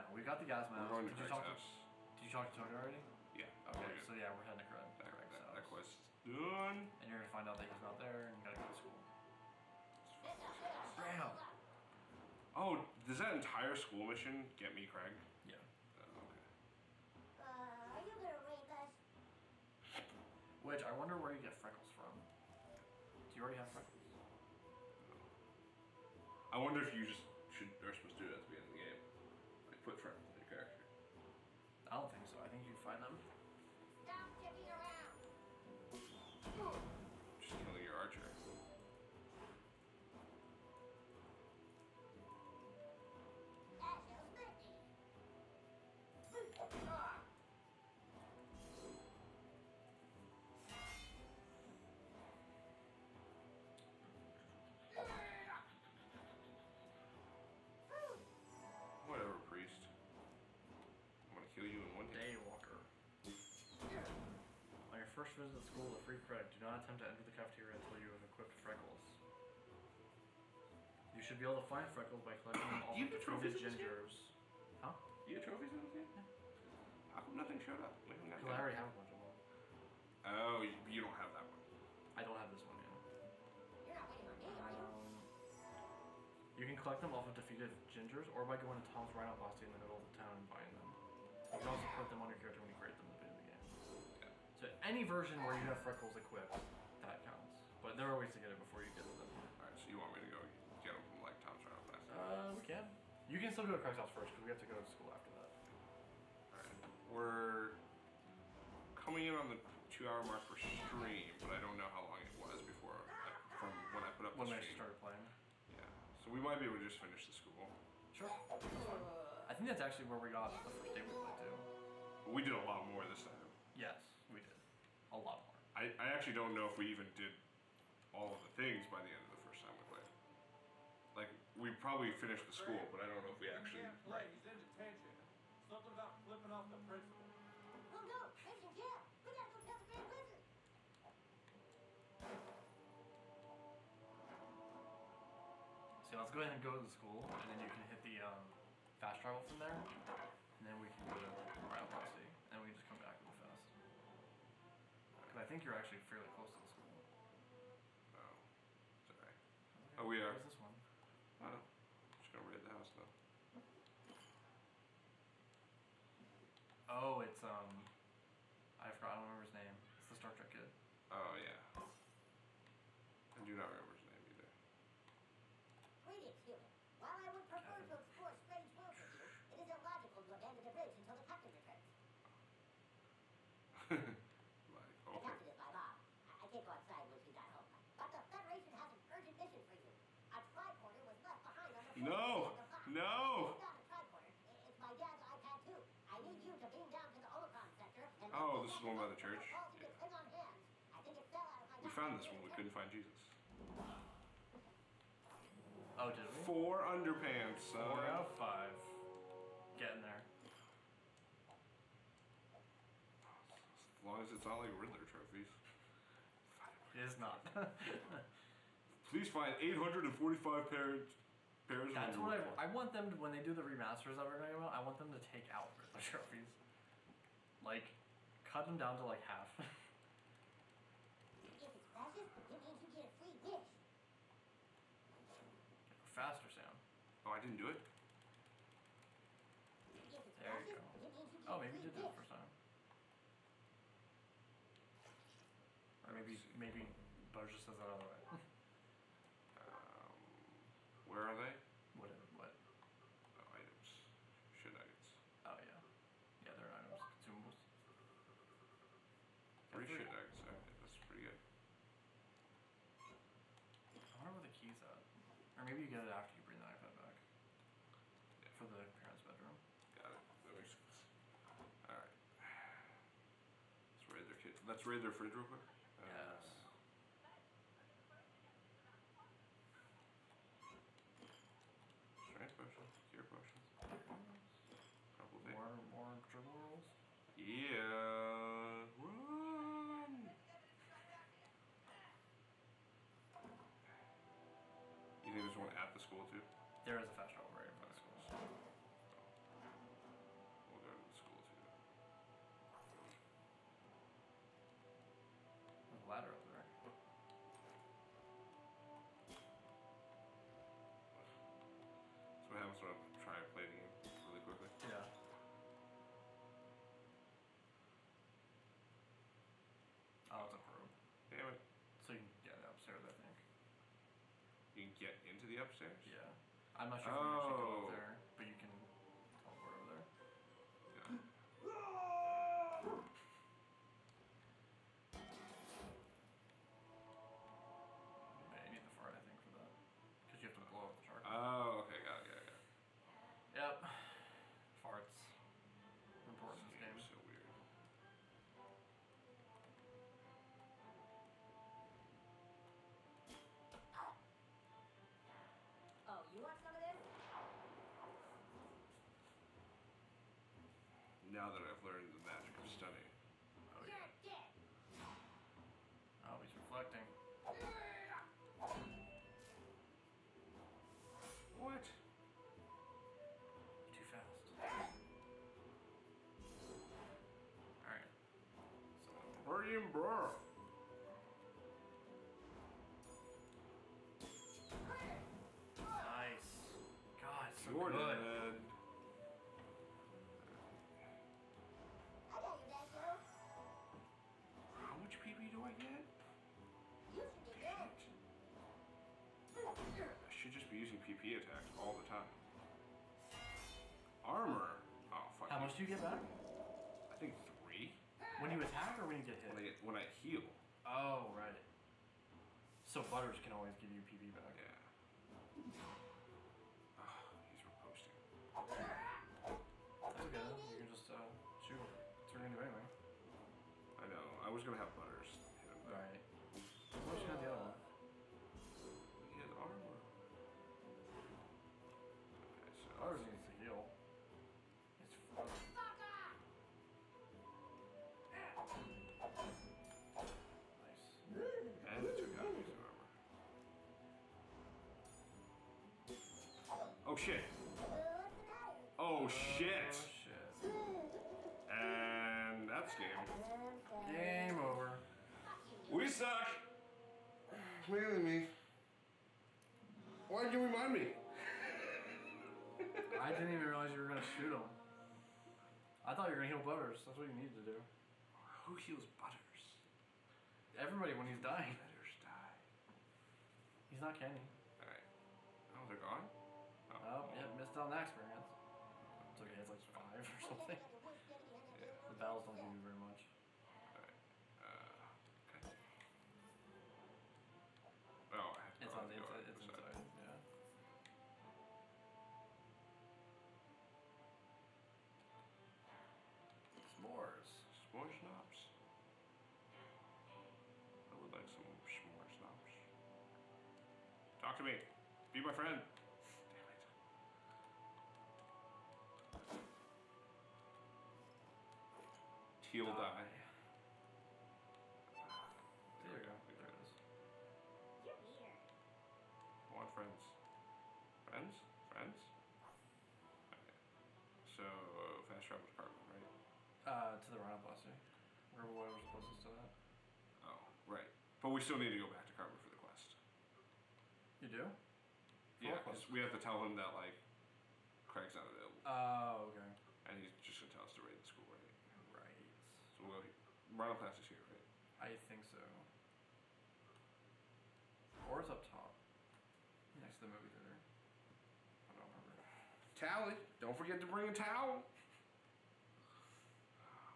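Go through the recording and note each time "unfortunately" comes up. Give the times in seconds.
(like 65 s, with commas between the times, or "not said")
not said.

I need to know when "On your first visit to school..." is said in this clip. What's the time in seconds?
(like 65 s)
64 s.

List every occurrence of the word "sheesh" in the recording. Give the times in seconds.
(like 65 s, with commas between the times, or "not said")
not said.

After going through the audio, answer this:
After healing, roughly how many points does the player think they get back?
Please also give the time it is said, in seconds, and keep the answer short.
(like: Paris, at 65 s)
3, at 407 s.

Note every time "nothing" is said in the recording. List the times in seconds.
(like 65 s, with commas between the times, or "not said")
77 s.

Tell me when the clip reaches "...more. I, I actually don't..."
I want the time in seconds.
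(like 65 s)
125 s.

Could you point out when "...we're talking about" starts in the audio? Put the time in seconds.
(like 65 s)
224 s.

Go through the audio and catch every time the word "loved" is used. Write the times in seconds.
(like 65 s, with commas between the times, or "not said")
not said.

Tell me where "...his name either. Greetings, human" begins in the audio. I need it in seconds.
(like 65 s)
173 s.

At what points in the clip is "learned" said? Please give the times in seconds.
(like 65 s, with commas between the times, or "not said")
361 s.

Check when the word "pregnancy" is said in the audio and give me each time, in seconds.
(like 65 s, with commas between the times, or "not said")
not said.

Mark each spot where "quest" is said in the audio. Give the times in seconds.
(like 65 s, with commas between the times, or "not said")
5 s, 532 s.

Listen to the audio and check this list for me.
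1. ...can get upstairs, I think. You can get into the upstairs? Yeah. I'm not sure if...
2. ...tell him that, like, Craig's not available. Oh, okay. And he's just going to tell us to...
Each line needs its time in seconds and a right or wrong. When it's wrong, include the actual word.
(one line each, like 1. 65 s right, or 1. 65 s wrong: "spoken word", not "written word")
1. 322 s right
2. 536 s right.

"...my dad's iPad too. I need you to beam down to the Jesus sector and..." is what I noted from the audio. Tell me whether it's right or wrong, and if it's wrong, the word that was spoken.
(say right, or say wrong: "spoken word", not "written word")
wrong: "Omicron", not "Jesus".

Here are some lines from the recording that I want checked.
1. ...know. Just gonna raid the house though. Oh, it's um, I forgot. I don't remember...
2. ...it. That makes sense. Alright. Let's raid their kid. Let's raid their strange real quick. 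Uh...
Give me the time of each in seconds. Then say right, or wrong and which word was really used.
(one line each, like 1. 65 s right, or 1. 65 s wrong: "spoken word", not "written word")
1. 161 s right
2. 270 s wrong: "fridge", not "strange".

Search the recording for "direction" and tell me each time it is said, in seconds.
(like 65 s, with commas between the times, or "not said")
not said.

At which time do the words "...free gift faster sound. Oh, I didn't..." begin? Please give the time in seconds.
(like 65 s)
233 s.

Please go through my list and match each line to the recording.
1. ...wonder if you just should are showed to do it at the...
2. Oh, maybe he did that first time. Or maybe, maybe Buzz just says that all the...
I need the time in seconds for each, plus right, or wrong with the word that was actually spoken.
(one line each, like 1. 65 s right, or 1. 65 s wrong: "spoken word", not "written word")
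1. 26 s wrong: "supposed", not "showed"
2. 241 s right.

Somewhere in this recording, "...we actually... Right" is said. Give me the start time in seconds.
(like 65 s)
133 s.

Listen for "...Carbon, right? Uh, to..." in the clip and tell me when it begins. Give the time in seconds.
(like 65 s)
525 s.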